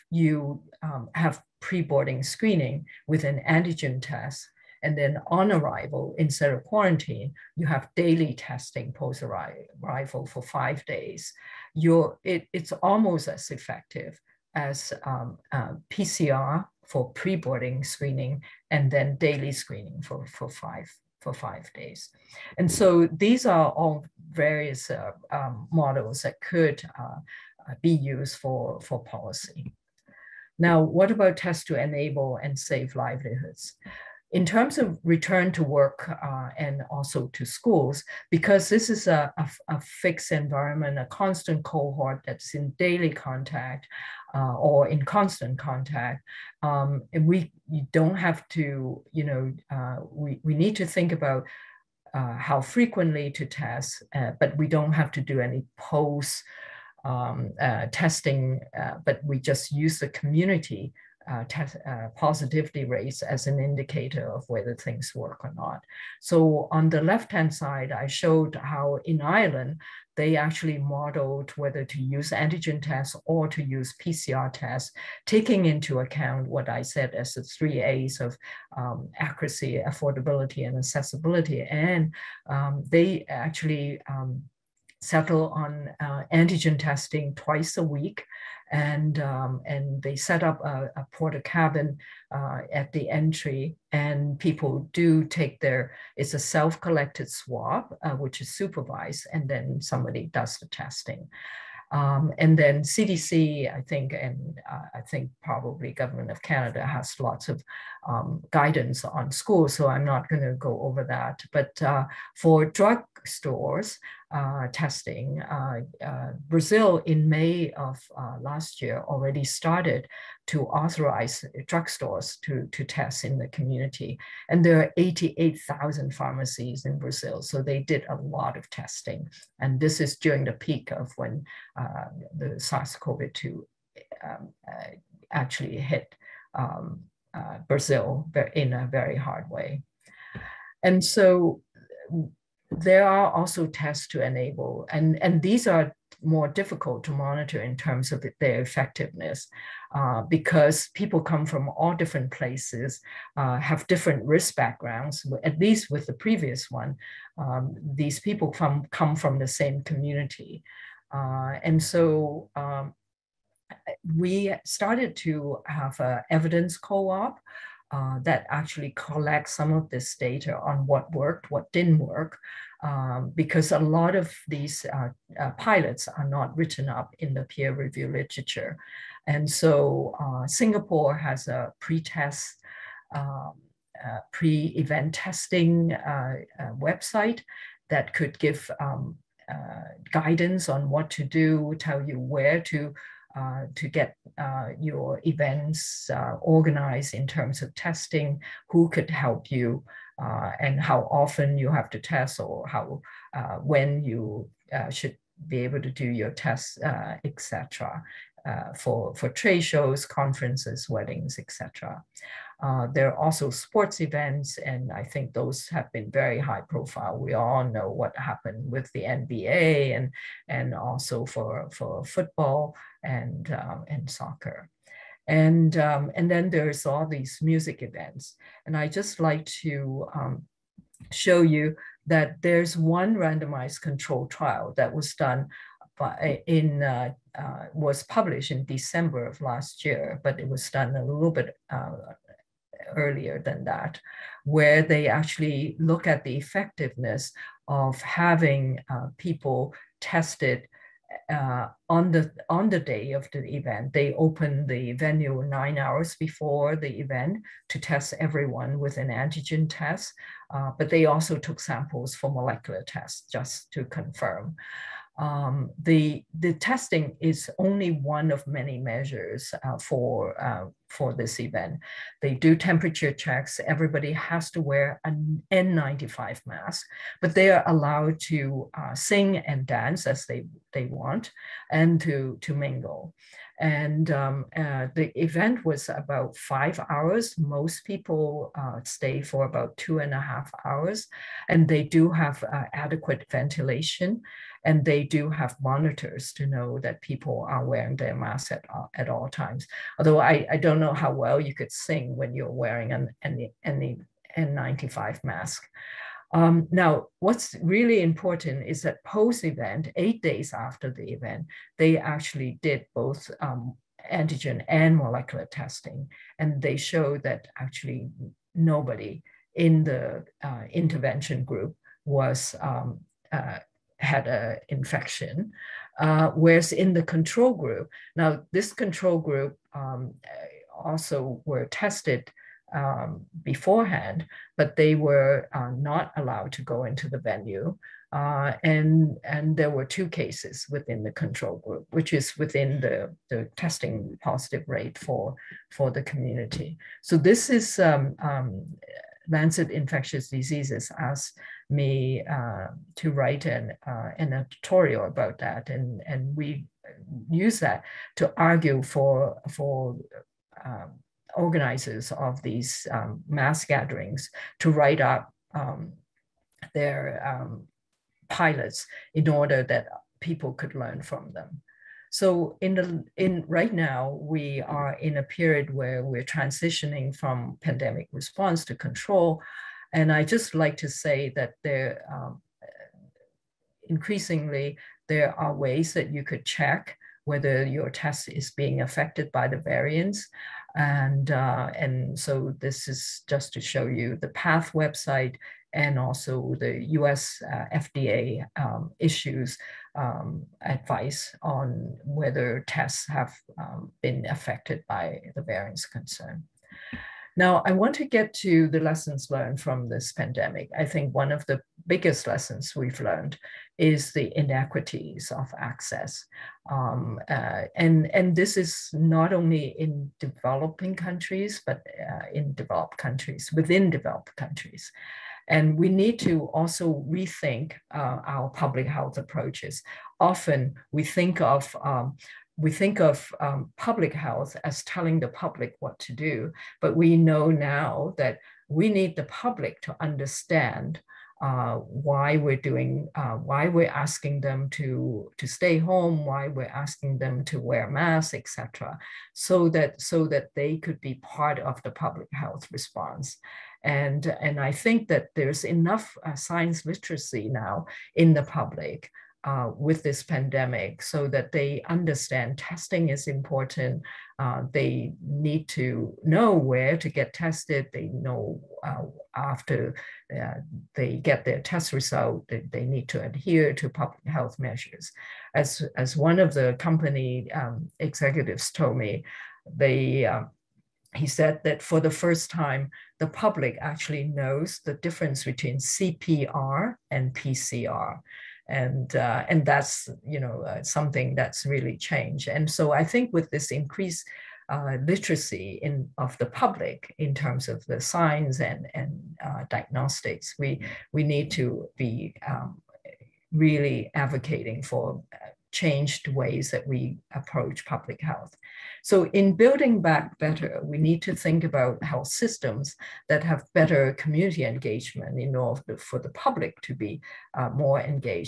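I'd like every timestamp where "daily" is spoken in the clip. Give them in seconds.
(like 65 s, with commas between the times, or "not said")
7 s, 19 s, 42 s.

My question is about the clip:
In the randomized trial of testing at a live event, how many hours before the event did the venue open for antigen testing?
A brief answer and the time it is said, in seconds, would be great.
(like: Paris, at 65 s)
9, at 255 s.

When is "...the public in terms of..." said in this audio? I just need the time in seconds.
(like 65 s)
496 s.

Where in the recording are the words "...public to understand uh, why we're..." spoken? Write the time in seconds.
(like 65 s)
439 s.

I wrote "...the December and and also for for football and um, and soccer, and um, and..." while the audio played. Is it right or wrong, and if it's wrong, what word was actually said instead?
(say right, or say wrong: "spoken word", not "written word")
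wrong: "NBA", not "December".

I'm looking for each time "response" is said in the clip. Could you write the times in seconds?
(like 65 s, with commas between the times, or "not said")
378 s, 452 s.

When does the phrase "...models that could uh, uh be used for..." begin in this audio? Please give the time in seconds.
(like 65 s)
25 s.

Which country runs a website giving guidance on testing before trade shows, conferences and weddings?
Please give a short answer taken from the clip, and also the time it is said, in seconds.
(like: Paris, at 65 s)
Singapore, at 180 s.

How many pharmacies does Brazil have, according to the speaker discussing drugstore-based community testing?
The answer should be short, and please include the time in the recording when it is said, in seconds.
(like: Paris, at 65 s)
88,000, at 124 s.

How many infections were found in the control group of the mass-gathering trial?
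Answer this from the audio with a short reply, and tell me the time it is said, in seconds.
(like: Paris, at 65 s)
2, at 339 s.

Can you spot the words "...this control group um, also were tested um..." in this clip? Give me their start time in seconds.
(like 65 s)
328 s.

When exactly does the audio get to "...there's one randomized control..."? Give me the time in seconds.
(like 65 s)
232 s.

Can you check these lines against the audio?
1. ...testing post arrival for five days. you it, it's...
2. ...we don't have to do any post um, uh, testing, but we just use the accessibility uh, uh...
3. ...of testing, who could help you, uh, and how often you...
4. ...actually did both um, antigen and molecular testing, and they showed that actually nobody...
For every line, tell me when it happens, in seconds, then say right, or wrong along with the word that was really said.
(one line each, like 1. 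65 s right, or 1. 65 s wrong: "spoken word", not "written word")
1. 8 s right
2. 54 s wrong: "community", not "accessibility"
3. 197 s right
4. 311 s right.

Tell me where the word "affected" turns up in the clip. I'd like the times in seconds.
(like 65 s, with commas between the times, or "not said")
388 s, 404 s.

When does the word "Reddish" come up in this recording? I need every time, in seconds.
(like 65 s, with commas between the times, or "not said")
not said.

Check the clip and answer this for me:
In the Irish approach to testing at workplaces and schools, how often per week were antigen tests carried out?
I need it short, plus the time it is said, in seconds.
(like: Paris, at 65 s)
twice a week, at 87 s.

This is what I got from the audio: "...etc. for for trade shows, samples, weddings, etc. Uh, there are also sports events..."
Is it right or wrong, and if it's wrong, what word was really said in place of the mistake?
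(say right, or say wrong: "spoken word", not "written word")
wrong: "conferences", not "samples".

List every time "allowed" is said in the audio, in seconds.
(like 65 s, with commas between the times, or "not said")
277 s, 336 s.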